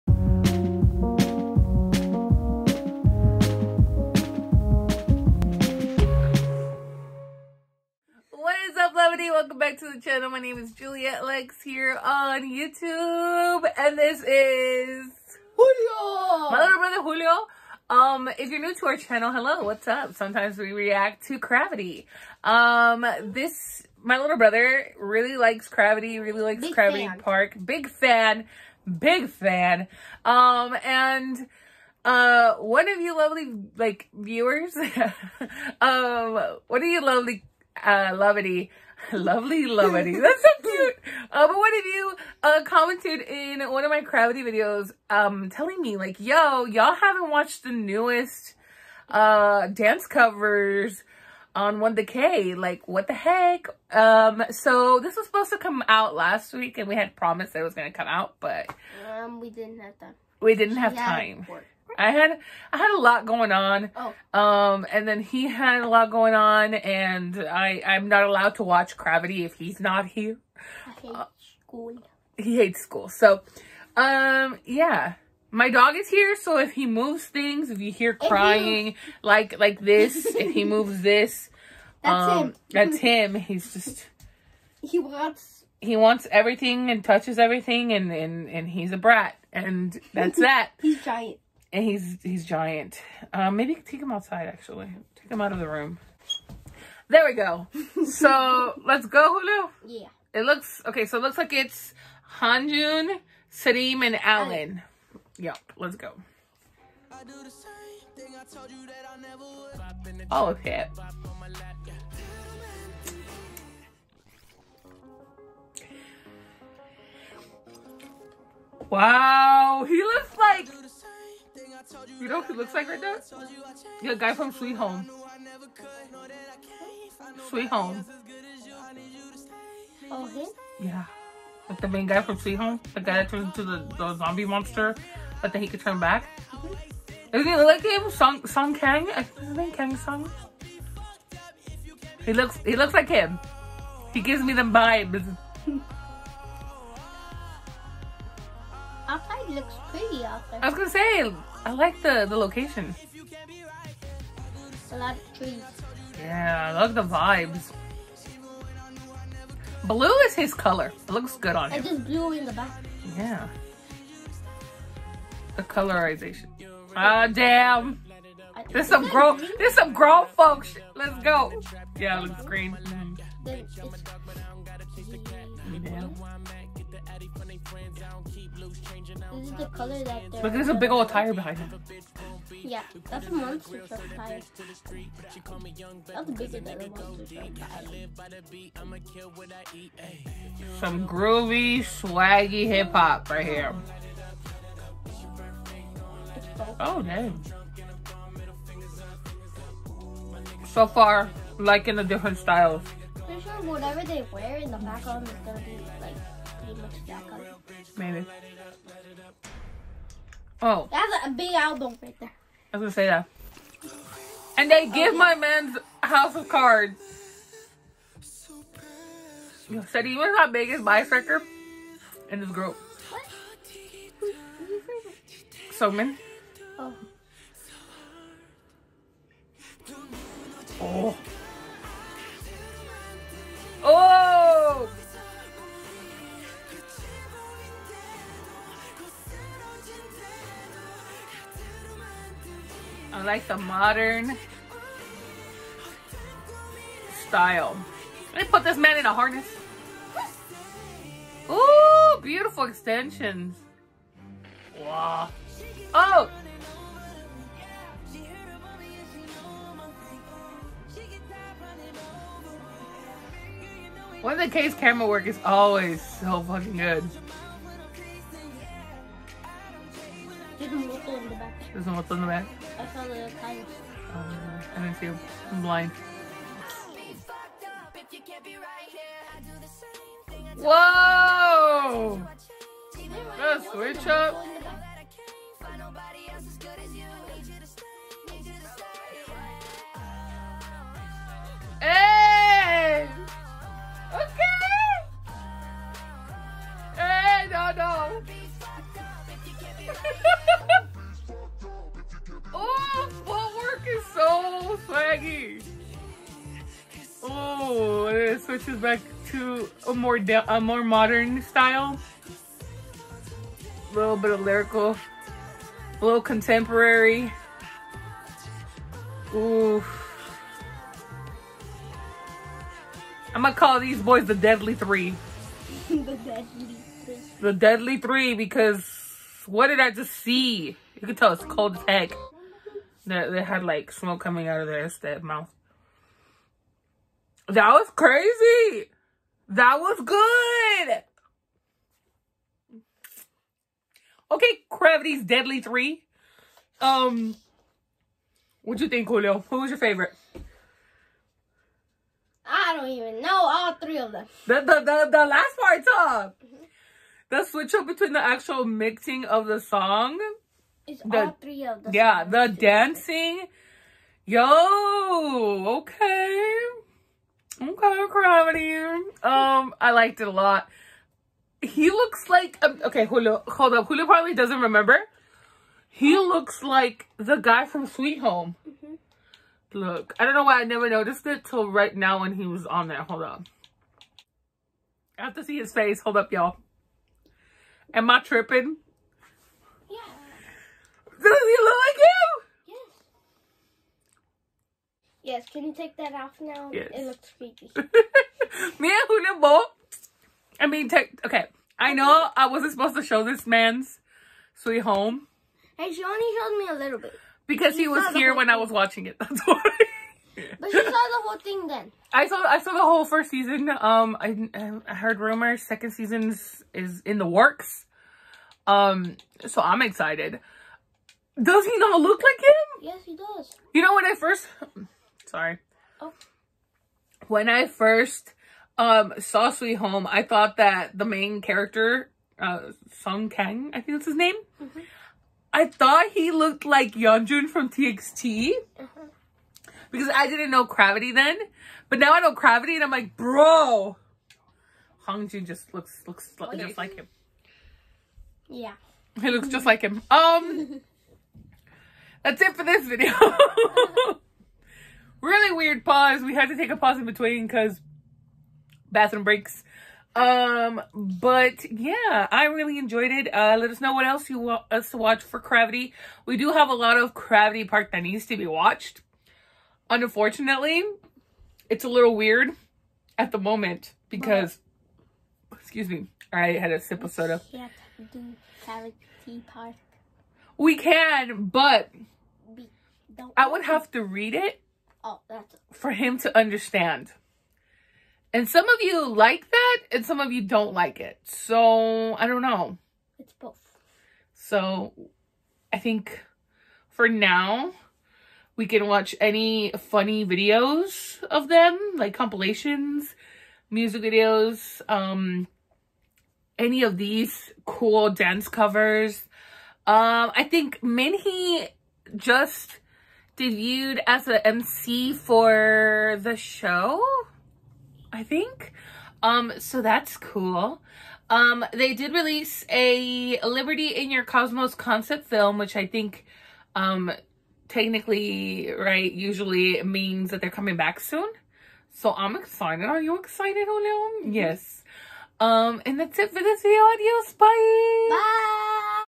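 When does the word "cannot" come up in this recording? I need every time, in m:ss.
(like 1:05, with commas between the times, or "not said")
not said.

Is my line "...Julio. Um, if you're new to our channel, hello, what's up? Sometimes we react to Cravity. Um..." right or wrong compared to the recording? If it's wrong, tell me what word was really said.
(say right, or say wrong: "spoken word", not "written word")
right.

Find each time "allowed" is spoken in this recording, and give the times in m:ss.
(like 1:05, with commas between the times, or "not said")
1:08.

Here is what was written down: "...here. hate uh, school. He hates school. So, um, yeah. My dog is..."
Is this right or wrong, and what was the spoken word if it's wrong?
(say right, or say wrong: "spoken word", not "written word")
right.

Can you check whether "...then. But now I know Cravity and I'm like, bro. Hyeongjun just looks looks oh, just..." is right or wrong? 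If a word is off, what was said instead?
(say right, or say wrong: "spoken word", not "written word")
right.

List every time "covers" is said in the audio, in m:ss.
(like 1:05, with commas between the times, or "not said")
0:50, 8:28.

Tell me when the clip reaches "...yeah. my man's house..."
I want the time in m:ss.
3:35.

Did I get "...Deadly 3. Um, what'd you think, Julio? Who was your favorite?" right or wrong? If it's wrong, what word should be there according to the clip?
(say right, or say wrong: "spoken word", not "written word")
right.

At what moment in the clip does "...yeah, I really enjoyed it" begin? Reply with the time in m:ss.
7:41.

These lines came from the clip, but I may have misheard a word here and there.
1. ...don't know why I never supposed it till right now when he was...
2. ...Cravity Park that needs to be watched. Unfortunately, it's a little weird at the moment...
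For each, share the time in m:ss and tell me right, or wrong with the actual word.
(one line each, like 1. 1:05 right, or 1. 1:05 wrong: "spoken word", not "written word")
1. 6:20 wrong: "noticed", not "supposed"
2. 7:47 right.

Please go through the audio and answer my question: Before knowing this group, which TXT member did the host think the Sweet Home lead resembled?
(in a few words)
Yeonjun.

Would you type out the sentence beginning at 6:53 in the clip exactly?
Um, I, I heard rumors second season is in the works.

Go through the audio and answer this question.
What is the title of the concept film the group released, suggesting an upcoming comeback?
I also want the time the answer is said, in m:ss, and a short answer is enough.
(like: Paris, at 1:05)
Liberty in Your Cosmos, at 8:43.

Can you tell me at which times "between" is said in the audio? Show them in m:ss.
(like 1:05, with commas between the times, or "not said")
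5:57, 7:37.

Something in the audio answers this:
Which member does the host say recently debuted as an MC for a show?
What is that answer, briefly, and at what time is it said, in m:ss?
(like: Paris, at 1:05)
Minhee, at 8:30.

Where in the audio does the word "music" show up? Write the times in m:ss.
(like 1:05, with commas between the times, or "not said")
8:23.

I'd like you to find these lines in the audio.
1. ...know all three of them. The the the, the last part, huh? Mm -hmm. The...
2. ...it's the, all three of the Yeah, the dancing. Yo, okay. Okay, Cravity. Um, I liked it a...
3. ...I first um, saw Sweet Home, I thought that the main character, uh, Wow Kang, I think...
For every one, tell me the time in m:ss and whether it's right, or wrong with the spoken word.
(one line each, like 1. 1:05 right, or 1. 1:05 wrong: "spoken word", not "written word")
1. 5:53 right
2. 6:00 right
3. 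7:07 wrong: "Song", not "Wow".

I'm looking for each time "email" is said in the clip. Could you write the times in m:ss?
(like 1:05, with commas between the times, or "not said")
not said.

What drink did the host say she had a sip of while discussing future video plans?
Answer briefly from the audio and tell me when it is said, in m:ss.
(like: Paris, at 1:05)
soda, at 7:57.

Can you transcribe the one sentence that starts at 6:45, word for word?
And she only showed me a little bit.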